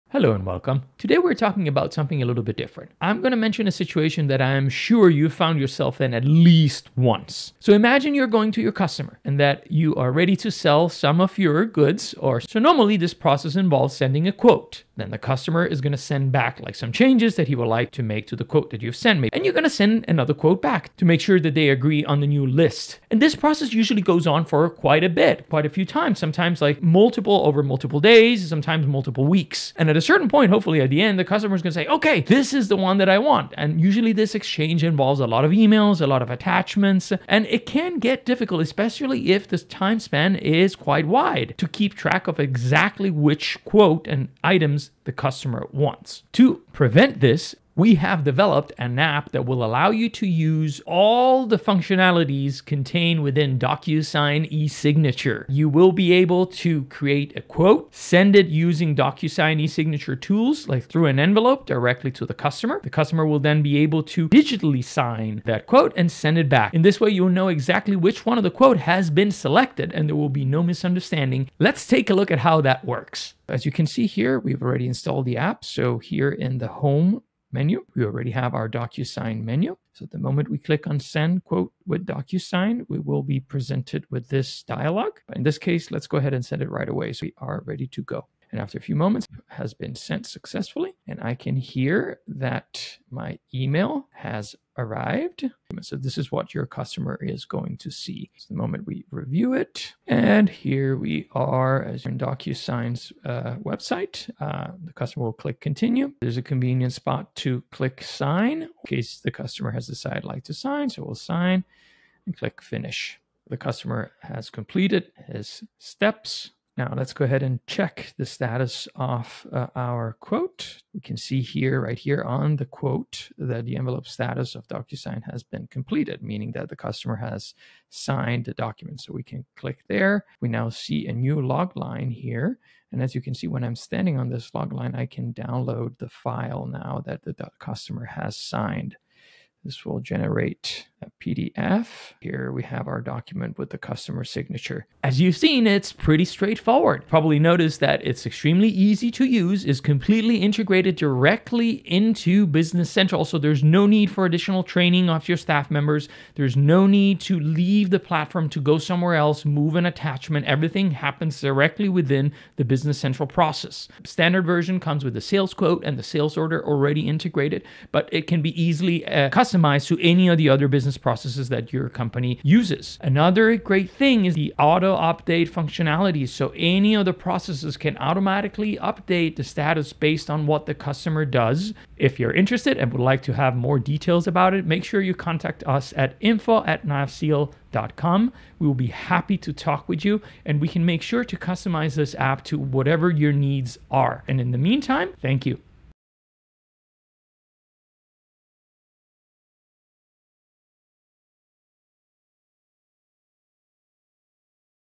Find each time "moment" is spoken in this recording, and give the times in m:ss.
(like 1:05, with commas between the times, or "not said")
1:20, 1:28, 1:38.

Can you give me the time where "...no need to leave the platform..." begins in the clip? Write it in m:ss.
2:36.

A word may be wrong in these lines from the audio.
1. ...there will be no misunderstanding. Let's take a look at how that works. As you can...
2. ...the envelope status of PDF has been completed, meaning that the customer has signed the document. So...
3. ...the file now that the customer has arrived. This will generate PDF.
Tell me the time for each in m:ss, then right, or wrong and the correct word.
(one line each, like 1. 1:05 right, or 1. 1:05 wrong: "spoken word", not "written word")
1. 1:10 right
2. 2:03 wrong: "DocuSign", not "PDF"
3. 2:15 wrong: "signed", not "arrived".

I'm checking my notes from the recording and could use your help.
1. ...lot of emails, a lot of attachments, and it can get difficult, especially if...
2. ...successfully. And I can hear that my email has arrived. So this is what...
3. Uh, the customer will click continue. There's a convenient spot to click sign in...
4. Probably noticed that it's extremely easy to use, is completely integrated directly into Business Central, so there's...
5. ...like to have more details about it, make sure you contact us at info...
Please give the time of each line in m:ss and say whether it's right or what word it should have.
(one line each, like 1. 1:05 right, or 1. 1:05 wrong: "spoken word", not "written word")
1. 0:35 right
2. 1:30 right
3. 1:44 right
4. 2:27 right
5. 3:03 right.